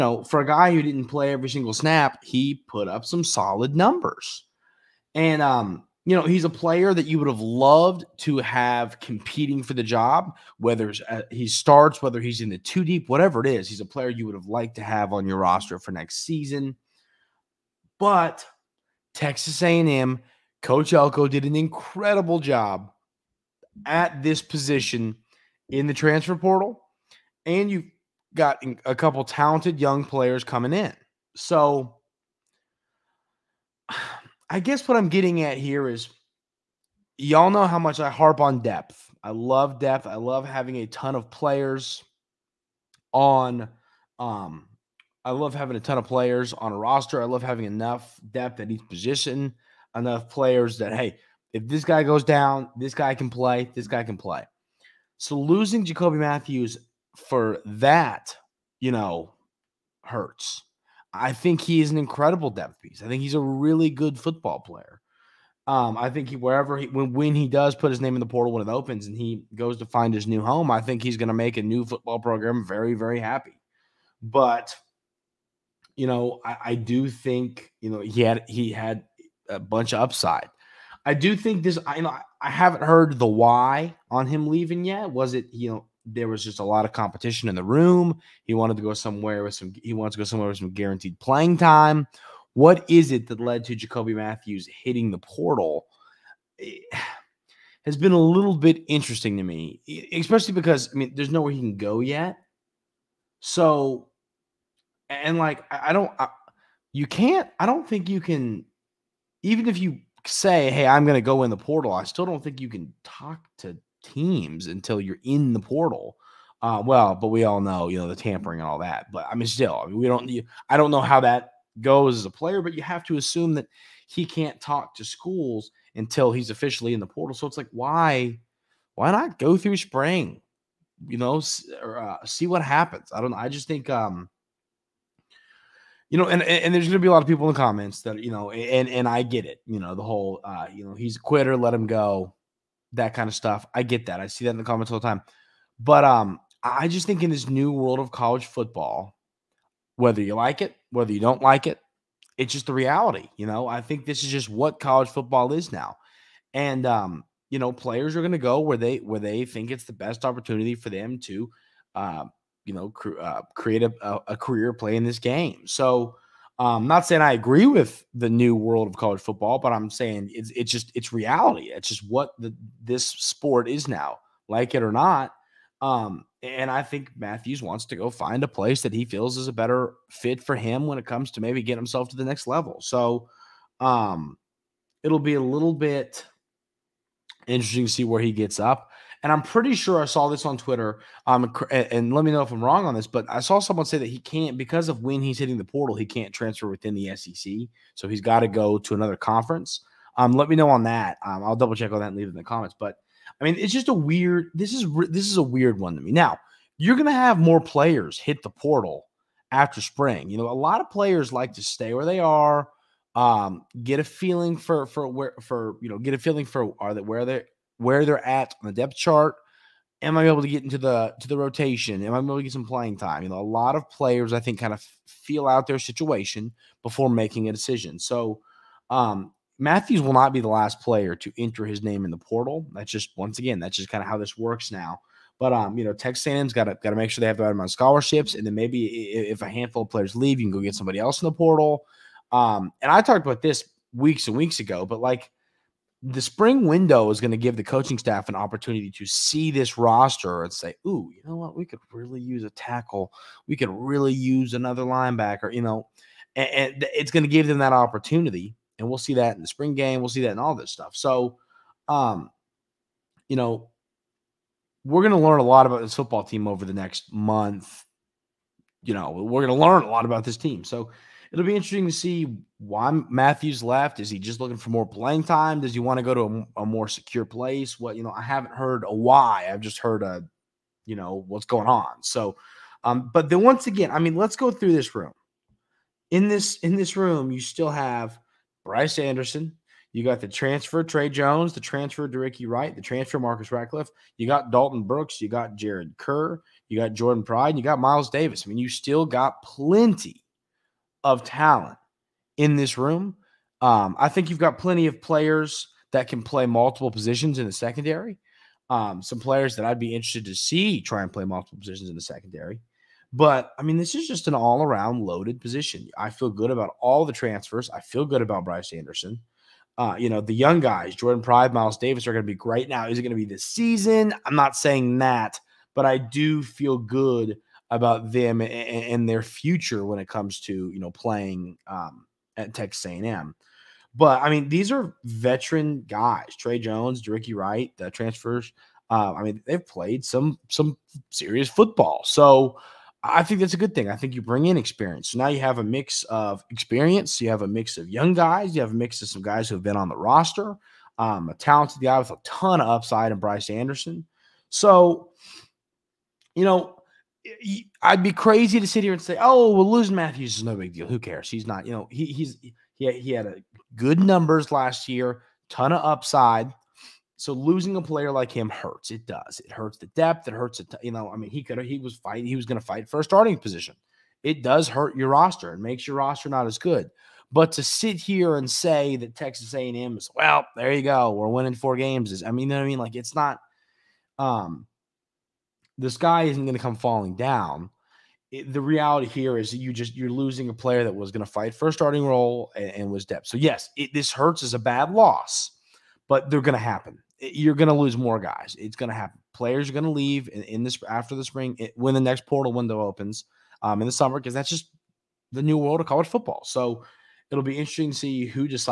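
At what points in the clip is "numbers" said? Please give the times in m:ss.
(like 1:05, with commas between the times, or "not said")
0:03, 6:04.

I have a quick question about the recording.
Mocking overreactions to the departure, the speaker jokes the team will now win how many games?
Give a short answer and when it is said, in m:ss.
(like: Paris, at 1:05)
4, at 6:21.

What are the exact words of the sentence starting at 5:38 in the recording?
Uh, I mean, they've played some some serious football, so I think that's a good thing.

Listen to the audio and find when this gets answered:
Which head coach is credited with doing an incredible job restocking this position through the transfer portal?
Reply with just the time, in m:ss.
0:20.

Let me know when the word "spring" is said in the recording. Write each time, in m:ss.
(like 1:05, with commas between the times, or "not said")
2:09, 3:29, 4:06, 4:19, 6:41.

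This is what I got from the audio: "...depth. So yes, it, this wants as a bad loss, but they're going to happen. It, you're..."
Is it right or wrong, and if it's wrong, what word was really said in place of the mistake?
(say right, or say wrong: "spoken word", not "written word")
wrong: "hurts", not "wants".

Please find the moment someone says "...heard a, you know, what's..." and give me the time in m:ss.
4:39.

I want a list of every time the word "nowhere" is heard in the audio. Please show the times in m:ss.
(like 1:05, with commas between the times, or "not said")
1:41.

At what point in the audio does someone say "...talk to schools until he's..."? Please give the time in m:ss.
2:04.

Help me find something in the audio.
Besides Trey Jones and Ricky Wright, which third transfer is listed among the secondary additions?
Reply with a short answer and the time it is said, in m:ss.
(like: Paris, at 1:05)
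Marcus Ratcliffe, at 4:53.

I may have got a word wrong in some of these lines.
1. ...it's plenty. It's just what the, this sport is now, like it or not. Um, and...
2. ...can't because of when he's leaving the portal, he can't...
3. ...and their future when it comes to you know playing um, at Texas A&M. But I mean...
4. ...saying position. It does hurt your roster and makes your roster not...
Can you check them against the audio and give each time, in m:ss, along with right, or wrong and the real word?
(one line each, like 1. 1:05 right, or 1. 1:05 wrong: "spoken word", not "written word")
1. 2:50 wrong: "reality", not "plenty"
2. 3:14 wrong: "hitting", not "leaving"
3. 5:28 right
4. 6:13 wrong: "starting", not "saying".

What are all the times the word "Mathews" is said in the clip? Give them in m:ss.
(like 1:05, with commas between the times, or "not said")
0:56, 1:34, 2:57, 3:49, 4:33, 5:59.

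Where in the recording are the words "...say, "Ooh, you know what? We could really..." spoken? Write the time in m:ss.
4:10.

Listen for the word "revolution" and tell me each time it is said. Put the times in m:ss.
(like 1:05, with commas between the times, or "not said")
not said.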